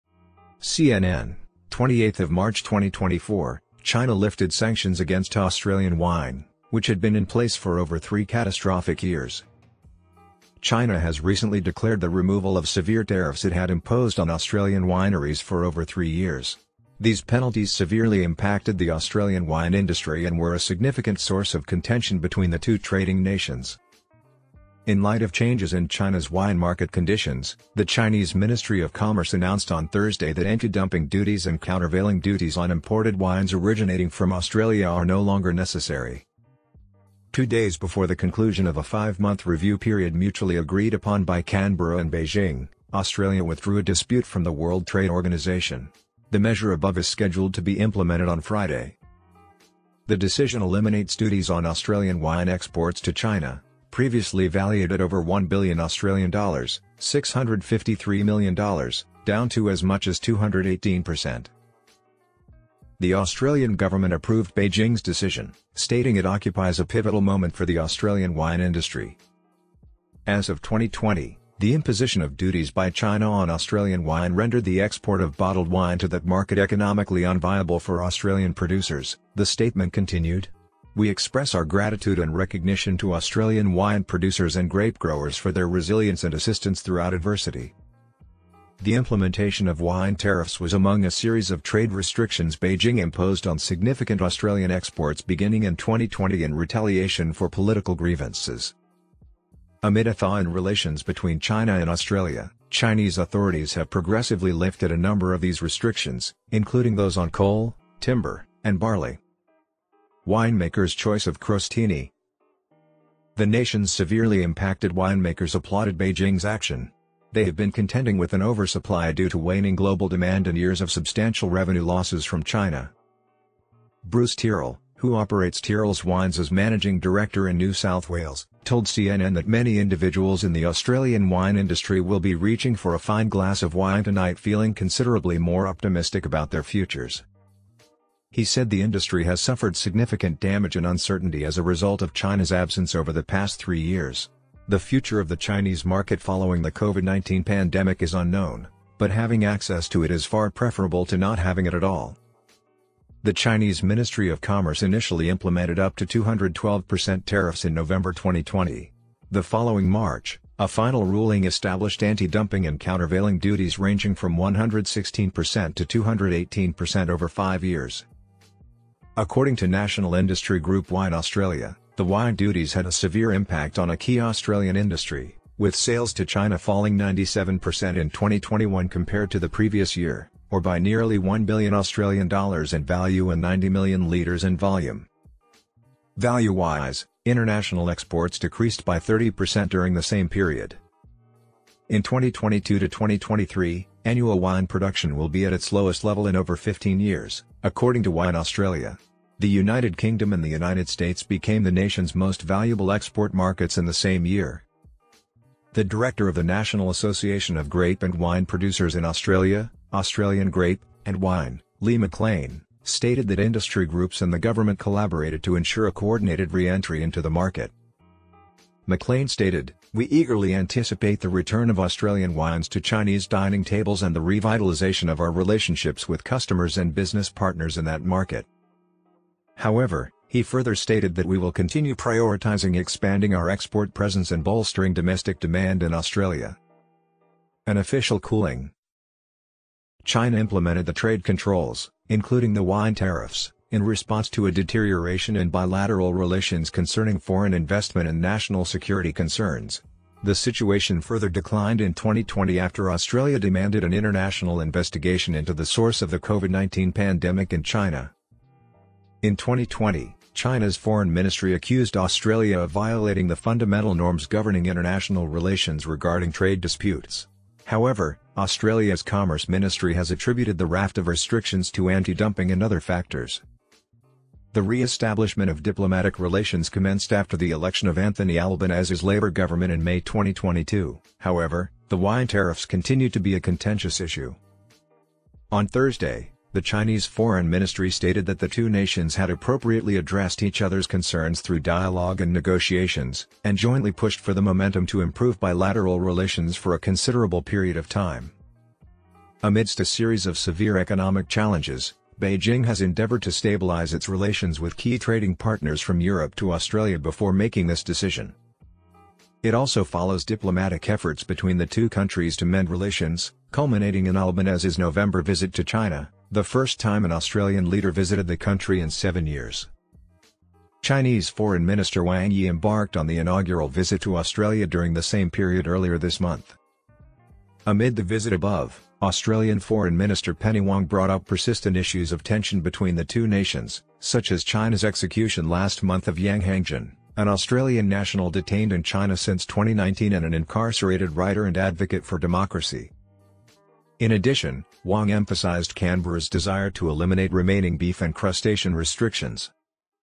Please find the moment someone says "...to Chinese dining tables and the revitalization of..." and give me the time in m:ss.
3:42.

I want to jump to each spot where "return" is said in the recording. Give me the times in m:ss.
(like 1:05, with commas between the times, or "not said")
3:41.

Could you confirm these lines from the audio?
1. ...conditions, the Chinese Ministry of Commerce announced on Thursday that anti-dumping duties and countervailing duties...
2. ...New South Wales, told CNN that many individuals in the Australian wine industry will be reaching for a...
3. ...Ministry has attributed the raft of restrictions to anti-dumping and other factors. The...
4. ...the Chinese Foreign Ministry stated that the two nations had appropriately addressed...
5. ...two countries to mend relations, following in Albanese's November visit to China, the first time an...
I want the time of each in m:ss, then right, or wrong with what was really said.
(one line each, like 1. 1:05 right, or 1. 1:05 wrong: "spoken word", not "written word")
1. 0:26 right
2. 2:07 right
3. 4:29 right
4. 4:46 right
5. 5:11 wrong: "culminating", not "following".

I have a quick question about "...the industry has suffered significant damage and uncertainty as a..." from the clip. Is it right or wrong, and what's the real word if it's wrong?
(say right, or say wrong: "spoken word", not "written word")
right.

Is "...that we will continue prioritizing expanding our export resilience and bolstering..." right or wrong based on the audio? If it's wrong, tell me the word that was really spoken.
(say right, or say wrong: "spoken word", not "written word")
wrong: "presence", not "resilience".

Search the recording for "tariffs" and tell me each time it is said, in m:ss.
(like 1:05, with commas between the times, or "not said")
0:13, 1:30, 2:37, 4:02, 4:42.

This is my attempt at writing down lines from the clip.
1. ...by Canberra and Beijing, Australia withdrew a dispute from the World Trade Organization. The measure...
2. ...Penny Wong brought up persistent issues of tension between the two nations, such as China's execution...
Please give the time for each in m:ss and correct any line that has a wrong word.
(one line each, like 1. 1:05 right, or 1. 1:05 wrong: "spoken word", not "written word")
1. 0:41 right
2. 5:30 right.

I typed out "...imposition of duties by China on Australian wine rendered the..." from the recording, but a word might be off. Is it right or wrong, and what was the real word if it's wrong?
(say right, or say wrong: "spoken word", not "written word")
right.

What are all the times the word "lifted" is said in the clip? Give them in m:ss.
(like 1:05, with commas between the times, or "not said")
0:04, 1:44.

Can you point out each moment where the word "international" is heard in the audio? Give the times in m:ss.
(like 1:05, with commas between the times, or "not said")
3:07, 4:13, 4:24.